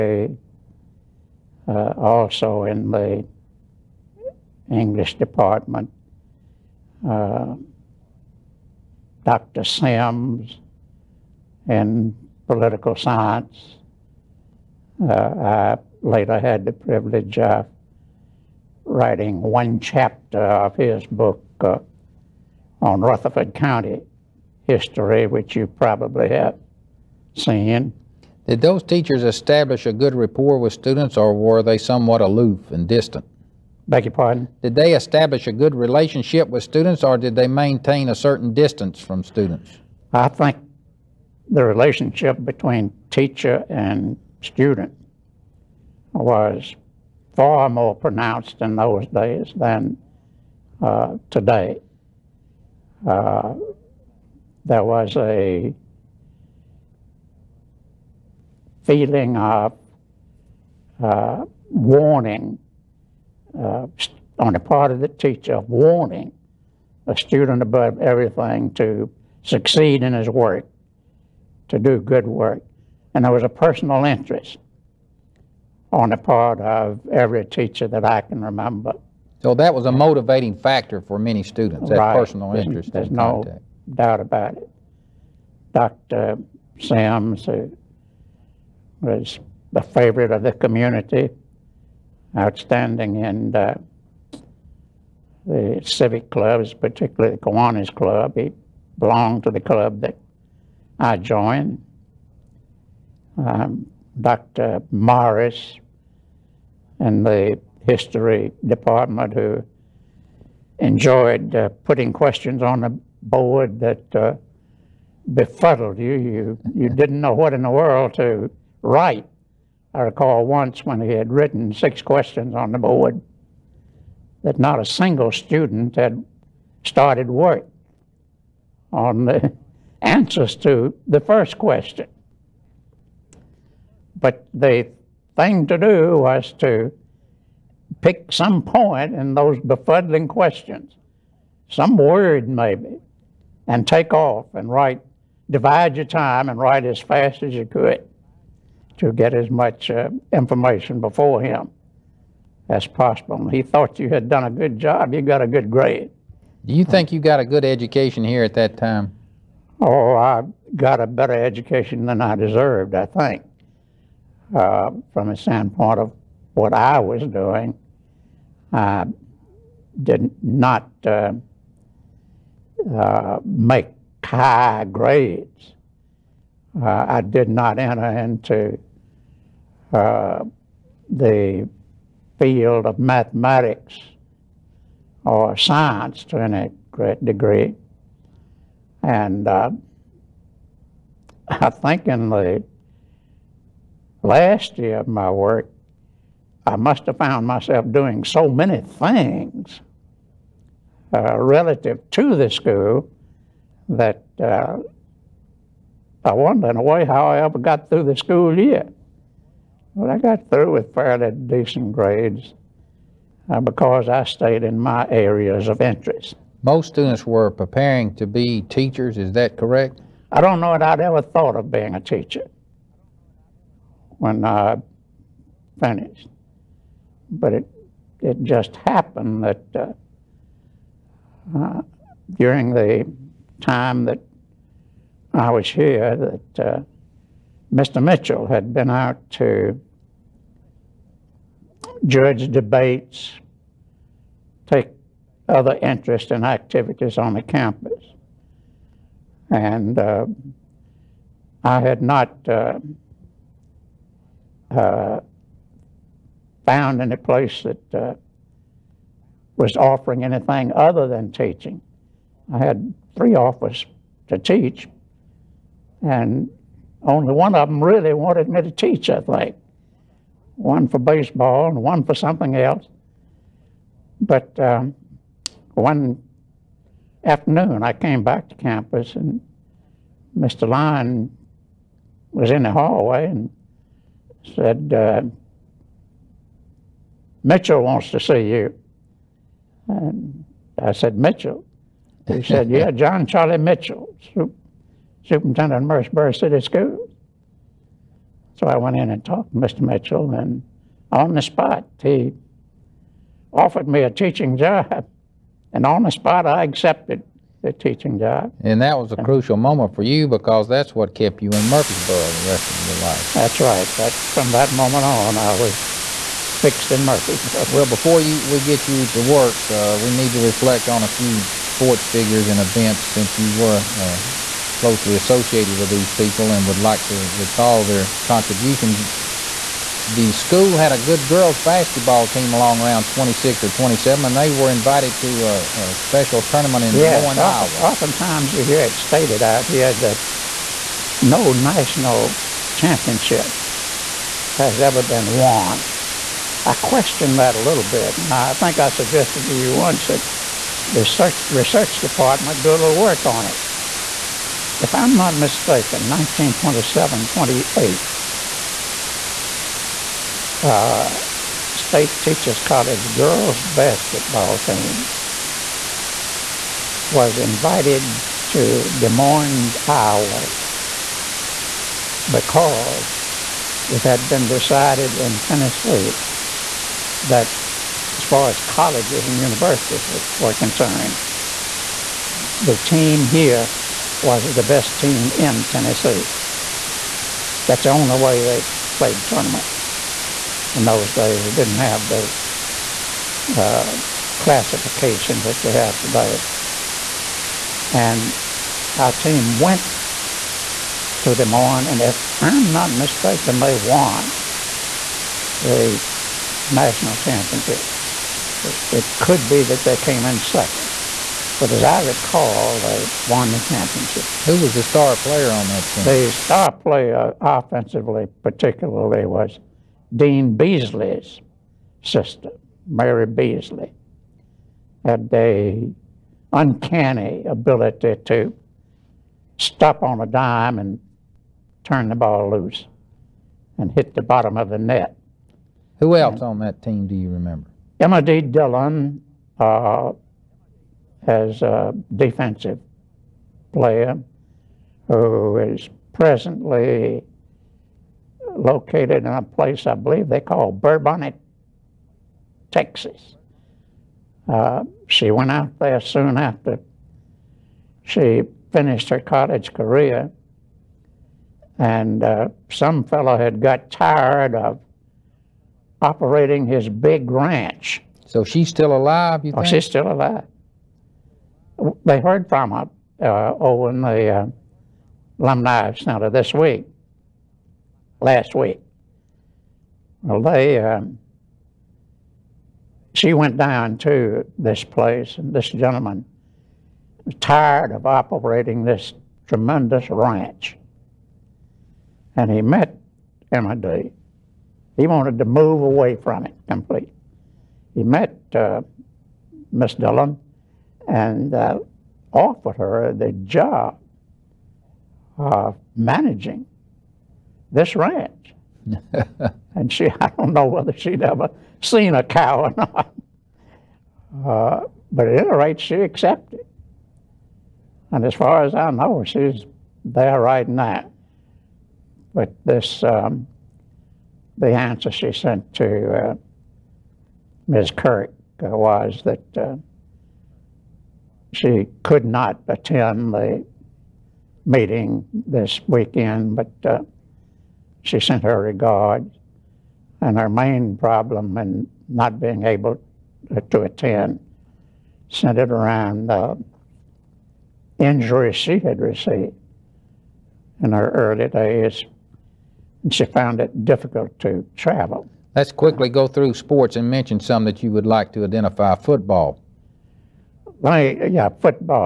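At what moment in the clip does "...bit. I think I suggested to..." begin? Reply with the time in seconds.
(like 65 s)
347 s.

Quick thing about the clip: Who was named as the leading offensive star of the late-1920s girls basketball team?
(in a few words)
Mary Beasley.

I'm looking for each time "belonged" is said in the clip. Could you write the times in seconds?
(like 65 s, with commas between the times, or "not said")
98 s.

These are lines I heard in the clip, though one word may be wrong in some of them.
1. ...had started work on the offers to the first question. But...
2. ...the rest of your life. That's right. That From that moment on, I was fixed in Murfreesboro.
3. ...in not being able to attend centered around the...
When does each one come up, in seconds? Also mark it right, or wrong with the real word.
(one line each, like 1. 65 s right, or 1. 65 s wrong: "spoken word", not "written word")
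1. 125 s wrong: "answers", not "offers"
2. 312 s right
3. 541 s right.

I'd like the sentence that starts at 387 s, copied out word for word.
That's the only way they played tournaments.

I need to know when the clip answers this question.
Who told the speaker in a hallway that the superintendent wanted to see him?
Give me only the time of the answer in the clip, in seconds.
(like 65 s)
280 s.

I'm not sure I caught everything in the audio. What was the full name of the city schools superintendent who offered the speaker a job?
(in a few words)
John Charlie Mitchell.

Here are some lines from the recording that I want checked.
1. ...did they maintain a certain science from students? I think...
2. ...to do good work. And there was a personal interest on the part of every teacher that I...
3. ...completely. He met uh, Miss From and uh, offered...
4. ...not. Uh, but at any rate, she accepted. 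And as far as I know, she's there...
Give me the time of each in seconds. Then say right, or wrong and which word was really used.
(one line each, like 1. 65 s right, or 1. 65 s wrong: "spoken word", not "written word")
1. 37 s wrong: "distance", not "science"
2. 71 s right
3. 496 s wrong: "Dillon", not "From"
4. 512 s right.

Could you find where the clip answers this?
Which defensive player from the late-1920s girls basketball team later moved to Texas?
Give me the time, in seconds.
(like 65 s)
437 s.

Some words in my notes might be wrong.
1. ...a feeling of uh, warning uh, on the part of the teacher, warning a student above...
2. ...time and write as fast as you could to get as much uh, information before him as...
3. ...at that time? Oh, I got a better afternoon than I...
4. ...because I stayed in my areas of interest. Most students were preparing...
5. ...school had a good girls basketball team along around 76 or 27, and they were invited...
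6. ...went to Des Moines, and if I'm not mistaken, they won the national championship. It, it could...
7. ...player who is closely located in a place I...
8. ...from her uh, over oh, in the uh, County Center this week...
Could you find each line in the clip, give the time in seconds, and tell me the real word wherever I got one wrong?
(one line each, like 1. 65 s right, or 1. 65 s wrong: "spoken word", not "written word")
1. 55 s right
2. 146 s right
3. 158 s wrong: "education", not "afternoon"
4. 213 s right
5. 330 s wrong: "26", not "76"
6. 399 s right
7. 443 s wrong: "presently", not "closely"
8. 472 s wrong: "Alumni", not "County".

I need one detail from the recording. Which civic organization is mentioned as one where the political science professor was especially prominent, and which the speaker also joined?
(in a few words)
Kiwanis Club.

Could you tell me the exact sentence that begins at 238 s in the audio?
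Mitchell had been out to judge debates, take other interests and activities on the campus.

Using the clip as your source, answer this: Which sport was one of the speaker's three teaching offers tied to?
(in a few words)
baseball.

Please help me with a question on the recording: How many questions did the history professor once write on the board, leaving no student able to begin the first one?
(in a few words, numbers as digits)
6.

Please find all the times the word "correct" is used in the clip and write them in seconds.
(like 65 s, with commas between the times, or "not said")
219 s.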